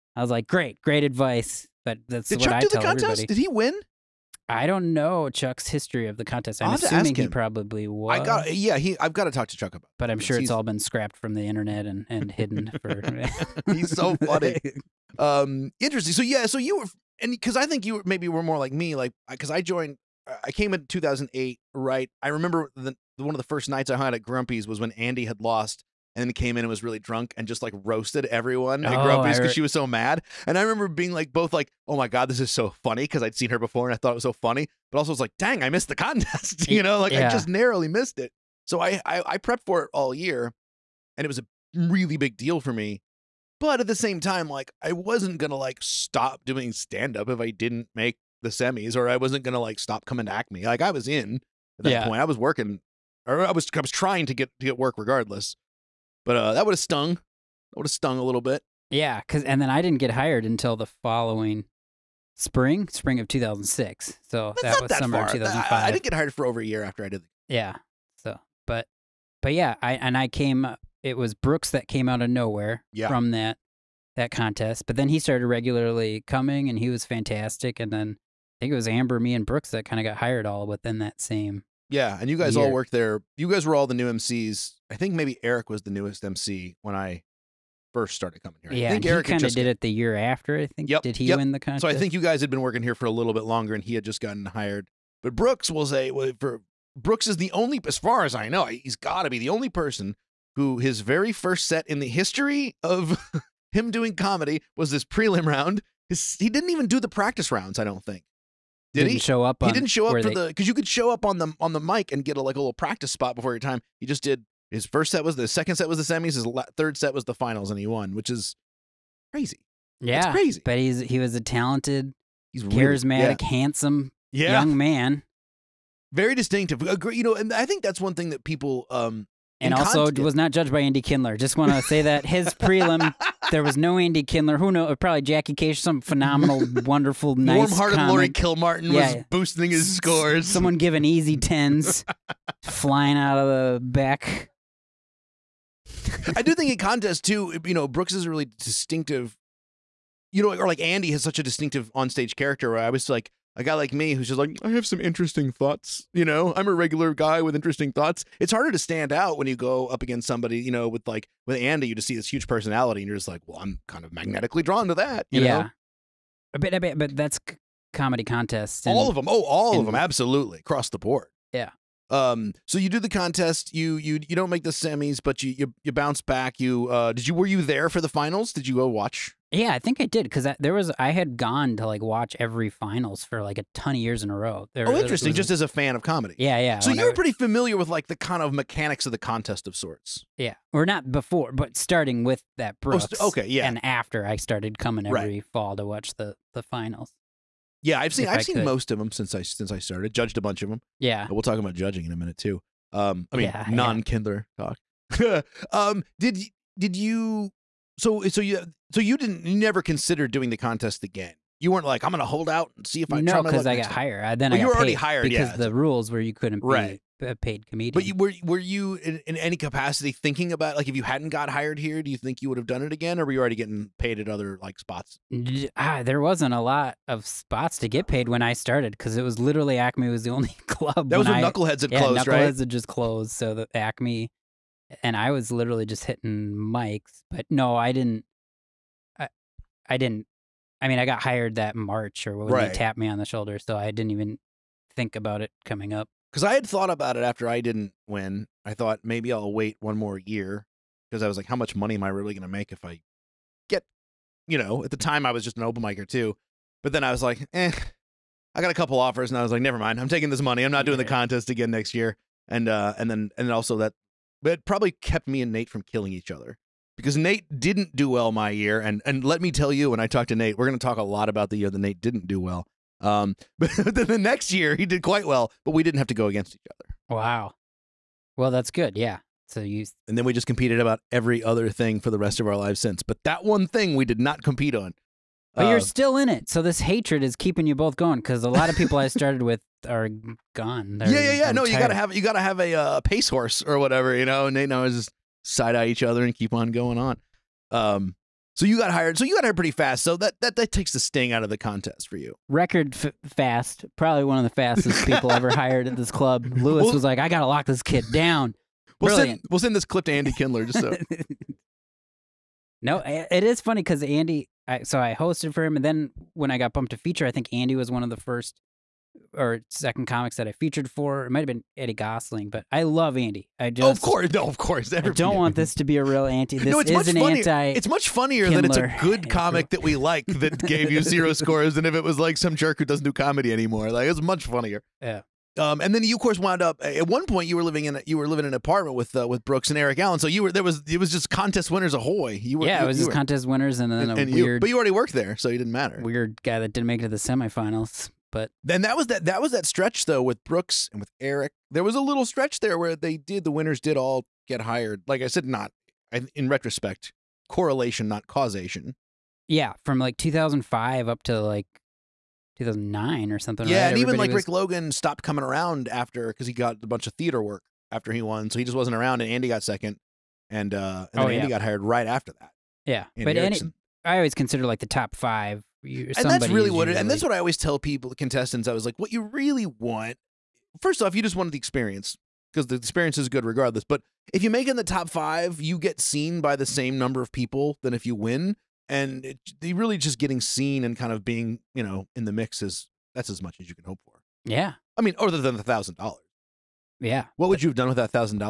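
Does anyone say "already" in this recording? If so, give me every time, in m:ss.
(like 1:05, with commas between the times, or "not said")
3:34, 3:43, 5:44.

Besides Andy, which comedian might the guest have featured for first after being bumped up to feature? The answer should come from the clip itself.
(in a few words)
Eddie Gosling.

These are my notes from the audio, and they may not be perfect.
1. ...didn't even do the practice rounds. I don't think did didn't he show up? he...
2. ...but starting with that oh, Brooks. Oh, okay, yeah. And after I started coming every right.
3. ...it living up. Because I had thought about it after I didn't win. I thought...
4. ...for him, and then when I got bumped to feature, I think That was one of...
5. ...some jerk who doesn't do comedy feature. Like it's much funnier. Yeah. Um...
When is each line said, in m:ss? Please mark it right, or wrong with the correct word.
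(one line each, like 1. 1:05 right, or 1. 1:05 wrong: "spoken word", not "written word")
1. 1:46 right
2. 3:11 right
3. 4:05 wrong: "coming", not "living"
4. 5:15 wrong: "Andy", not "That"
5. 5:32 wrong: "anymore", not "feature".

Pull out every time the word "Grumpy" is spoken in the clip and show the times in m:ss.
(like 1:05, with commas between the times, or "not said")
0:24, 0:29.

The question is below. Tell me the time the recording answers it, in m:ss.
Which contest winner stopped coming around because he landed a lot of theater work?
6:04.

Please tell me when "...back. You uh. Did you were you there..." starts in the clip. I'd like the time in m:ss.
2:56.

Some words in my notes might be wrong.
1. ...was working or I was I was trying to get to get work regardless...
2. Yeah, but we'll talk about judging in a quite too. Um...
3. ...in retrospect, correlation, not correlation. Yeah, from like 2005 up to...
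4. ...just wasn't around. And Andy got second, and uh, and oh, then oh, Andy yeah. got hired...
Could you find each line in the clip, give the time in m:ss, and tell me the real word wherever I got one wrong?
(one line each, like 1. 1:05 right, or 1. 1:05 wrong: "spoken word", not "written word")
1. 0:52 right
2. 3:20 wrong: "minute", not "quite"
3. 5:56 wrong: "causation", not "correlation"
4. 6:08 right.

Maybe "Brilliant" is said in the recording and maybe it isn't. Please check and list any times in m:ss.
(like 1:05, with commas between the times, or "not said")
5:09.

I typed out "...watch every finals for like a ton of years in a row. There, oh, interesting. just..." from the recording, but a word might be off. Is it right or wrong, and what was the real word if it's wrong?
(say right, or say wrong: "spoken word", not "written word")
right.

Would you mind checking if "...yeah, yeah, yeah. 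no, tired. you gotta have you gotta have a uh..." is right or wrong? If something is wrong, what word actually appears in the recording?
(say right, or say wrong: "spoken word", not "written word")
right.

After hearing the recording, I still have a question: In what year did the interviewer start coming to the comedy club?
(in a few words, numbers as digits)
2008.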